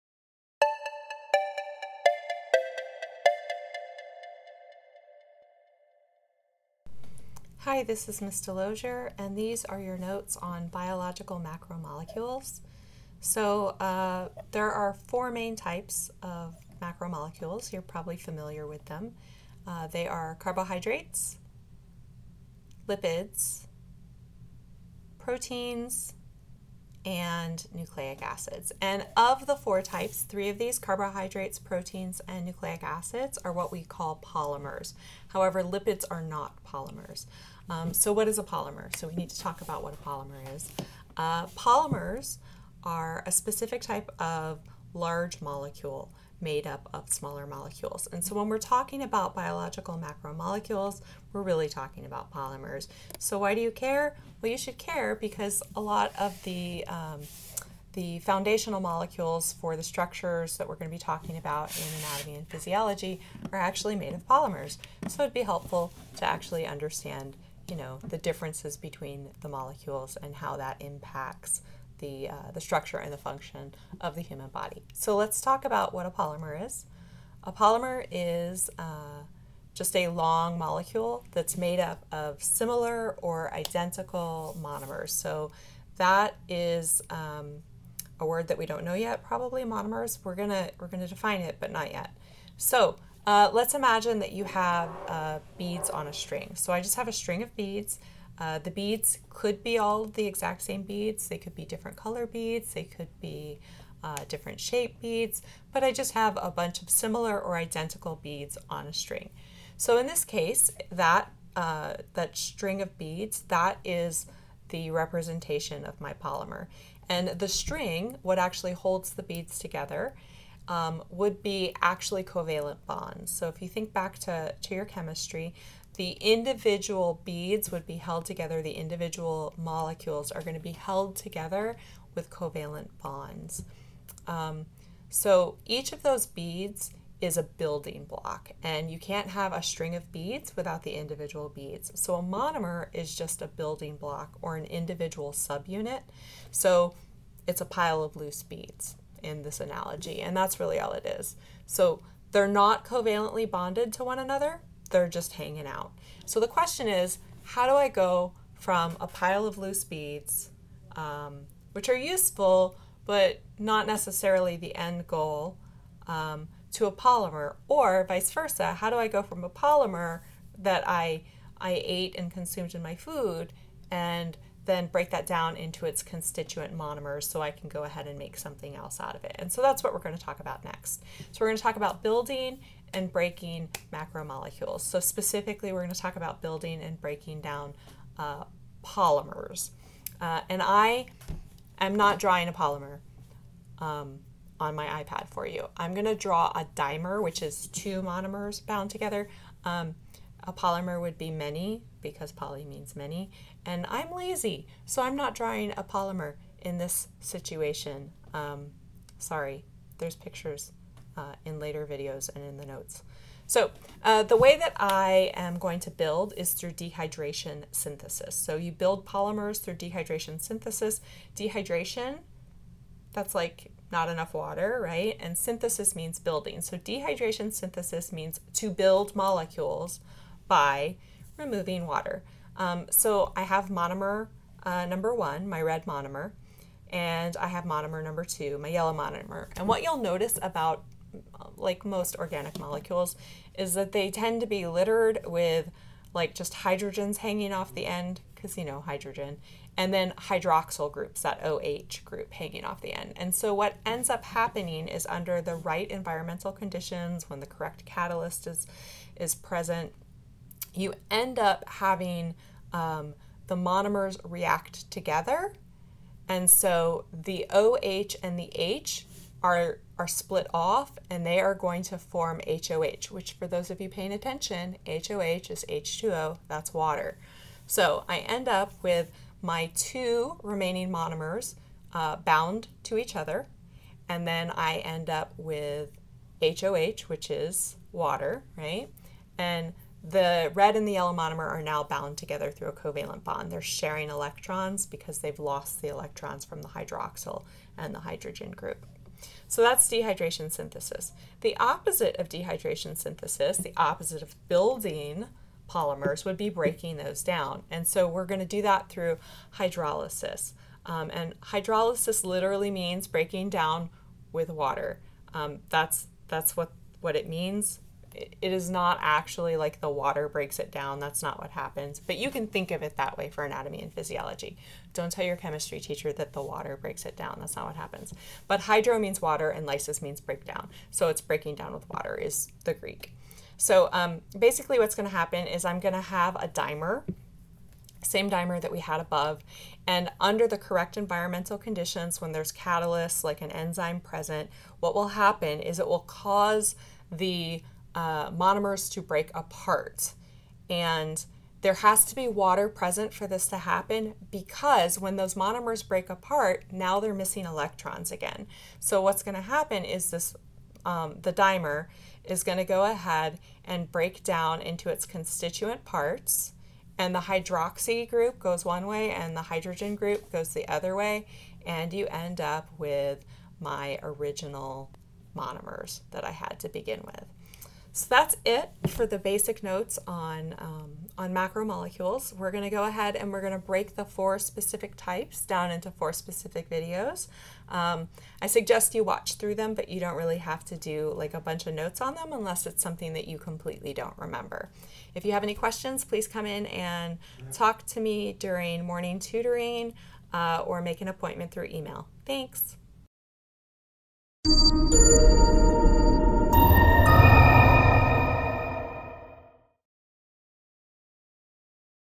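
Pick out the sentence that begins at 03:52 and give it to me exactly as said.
Um, so I have monomer uh, number one, my red monomer, and I have monomer number two, my yellow monomer.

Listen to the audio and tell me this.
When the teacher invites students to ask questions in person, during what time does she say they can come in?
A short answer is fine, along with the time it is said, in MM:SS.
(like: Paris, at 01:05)
Morning tutoring, at 06:38.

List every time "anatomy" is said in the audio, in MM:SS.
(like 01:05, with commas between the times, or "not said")
01:01, 05:23.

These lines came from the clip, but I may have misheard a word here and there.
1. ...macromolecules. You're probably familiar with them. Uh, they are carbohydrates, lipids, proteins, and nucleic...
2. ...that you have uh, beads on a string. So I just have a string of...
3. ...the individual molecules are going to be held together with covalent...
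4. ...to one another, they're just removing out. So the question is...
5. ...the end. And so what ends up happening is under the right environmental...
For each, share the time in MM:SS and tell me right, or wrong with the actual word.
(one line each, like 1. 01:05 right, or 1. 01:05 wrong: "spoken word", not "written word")
1. 00:16 right
2. 01:34 right
3. 02:08 right
4. 02:33 wrong: "hanging", not "removing"
5. 04:12 right.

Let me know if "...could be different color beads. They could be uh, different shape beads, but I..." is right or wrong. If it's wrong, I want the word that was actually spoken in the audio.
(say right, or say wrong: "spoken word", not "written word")
right.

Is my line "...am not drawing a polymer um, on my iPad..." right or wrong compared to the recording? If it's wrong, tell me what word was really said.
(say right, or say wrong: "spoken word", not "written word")
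right.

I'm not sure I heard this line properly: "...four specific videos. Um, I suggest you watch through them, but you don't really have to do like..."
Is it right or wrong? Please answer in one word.
right.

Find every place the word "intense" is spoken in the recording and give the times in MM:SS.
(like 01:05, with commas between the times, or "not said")
not said.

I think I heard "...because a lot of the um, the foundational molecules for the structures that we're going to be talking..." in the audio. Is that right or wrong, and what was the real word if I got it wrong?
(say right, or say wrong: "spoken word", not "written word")
right.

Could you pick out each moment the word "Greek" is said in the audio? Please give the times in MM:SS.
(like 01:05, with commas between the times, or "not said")
05:32.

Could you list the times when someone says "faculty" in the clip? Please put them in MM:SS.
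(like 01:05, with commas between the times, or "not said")
not said.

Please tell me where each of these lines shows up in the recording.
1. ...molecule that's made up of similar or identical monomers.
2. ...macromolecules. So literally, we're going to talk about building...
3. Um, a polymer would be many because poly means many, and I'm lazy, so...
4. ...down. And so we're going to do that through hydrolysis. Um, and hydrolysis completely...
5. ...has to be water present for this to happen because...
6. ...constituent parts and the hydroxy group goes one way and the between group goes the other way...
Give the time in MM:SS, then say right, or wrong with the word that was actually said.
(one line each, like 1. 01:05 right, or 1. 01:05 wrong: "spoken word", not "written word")
1. 01:20 right
2. 03:03 wrong: "specifically", not "literally"
3. 03:19 right
4. 05:07 wrong: "literally", not "completely"
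5. 05:51 right
6. 06:05 wrong: "hydrogen", not "between".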